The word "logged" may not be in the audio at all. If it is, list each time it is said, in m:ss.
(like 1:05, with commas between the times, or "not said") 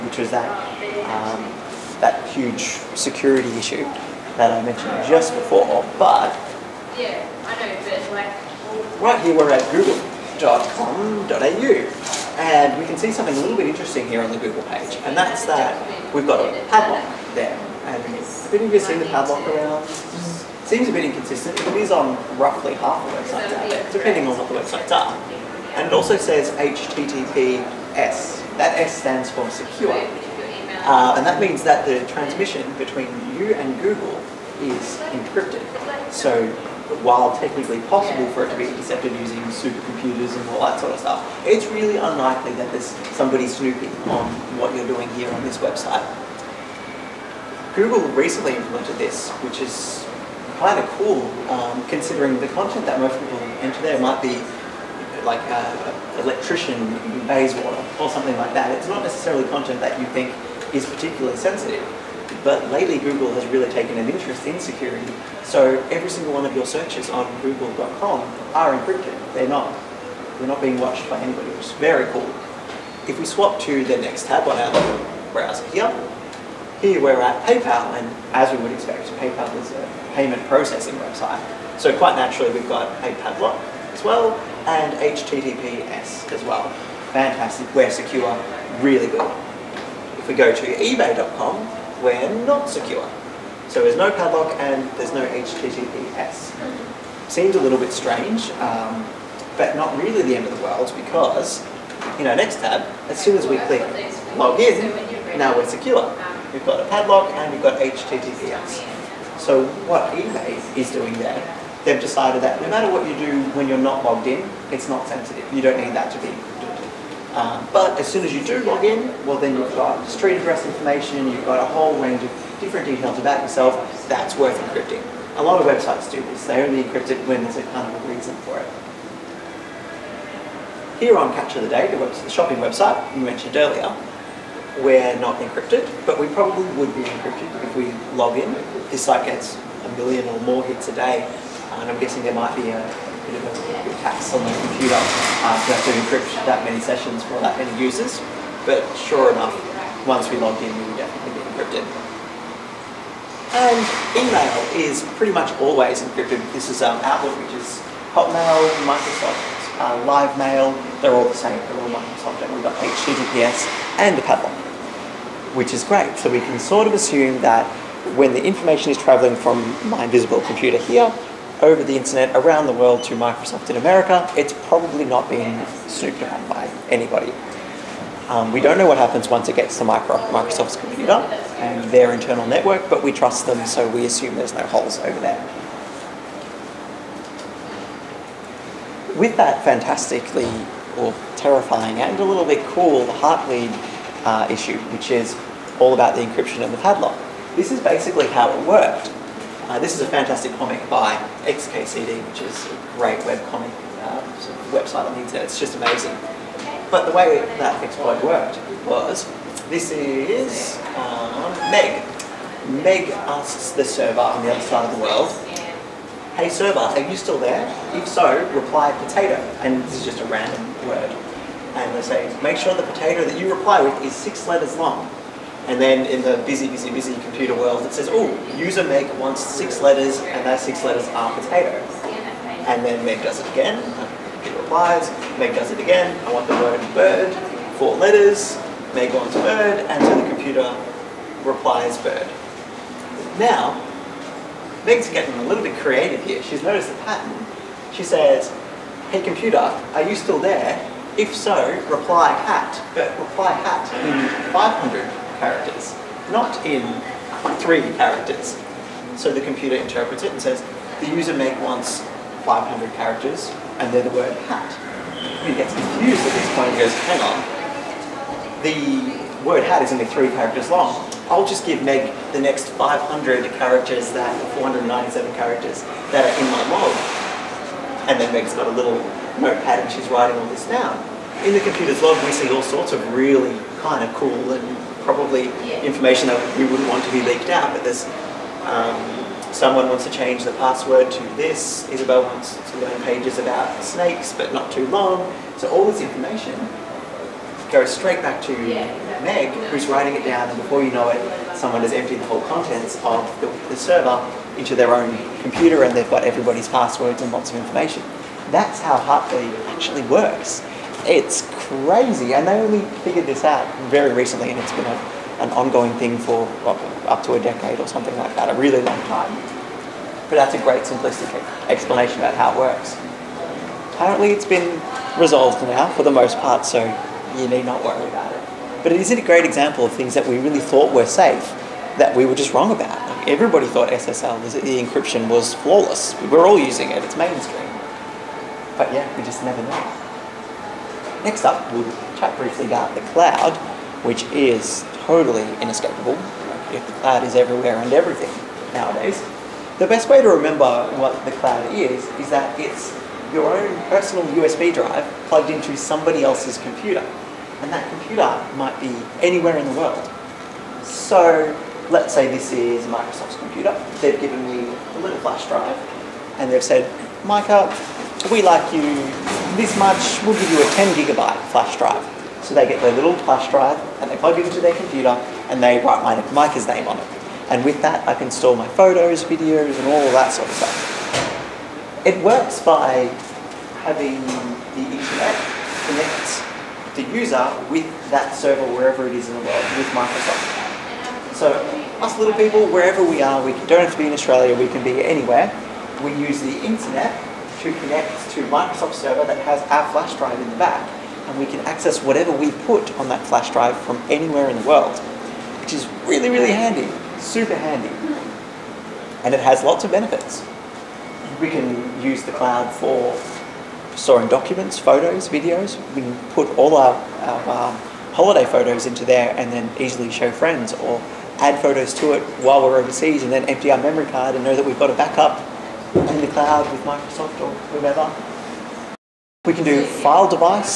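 1:54, 2:30.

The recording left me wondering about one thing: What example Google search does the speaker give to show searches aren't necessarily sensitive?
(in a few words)
An electrician in Bayswater.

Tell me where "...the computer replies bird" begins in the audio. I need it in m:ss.
4:00.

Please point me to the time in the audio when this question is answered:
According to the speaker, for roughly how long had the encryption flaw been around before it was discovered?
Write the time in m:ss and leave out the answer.
5:17.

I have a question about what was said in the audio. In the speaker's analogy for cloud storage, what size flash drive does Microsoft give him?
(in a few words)
10 gigabytes.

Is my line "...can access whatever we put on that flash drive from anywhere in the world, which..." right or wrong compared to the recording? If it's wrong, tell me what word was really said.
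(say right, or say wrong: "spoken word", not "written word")
right.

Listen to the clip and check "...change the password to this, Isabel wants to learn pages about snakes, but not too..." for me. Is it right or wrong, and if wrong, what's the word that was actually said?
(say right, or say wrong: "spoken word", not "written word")
right.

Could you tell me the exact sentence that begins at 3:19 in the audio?
Uh, this is a fantastic comic by XKCD, which is a great web uh, sort of website on the internet.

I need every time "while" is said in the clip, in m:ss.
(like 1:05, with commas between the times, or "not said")
0:37, 7:02.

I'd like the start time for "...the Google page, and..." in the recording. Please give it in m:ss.
0:14.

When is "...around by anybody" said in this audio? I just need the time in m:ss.
2:56.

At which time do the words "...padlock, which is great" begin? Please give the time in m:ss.
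2:44.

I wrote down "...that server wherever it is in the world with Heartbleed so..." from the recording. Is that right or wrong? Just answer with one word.
wrong.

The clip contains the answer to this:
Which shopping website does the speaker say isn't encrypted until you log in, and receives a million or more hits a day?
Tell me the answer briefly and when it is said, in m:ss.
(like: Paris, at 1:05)
Catch of the Day, at 2:11.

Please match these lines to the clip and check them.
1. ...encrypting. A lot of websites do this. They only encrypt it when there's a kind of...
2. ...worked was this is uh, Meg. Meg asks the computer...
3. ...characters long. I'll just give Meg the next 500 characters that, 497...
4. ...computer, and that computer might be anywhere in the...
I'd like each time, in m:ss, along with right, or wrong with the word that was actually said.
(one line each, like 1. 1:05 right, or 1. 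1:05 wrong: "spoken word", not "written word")
1. 2:04 right
2. 3:28 wrong: "server", not "computer"
3. 4:30 right
4. 5:56 right.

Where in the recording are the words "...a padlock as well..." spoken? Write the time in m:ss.
1:23.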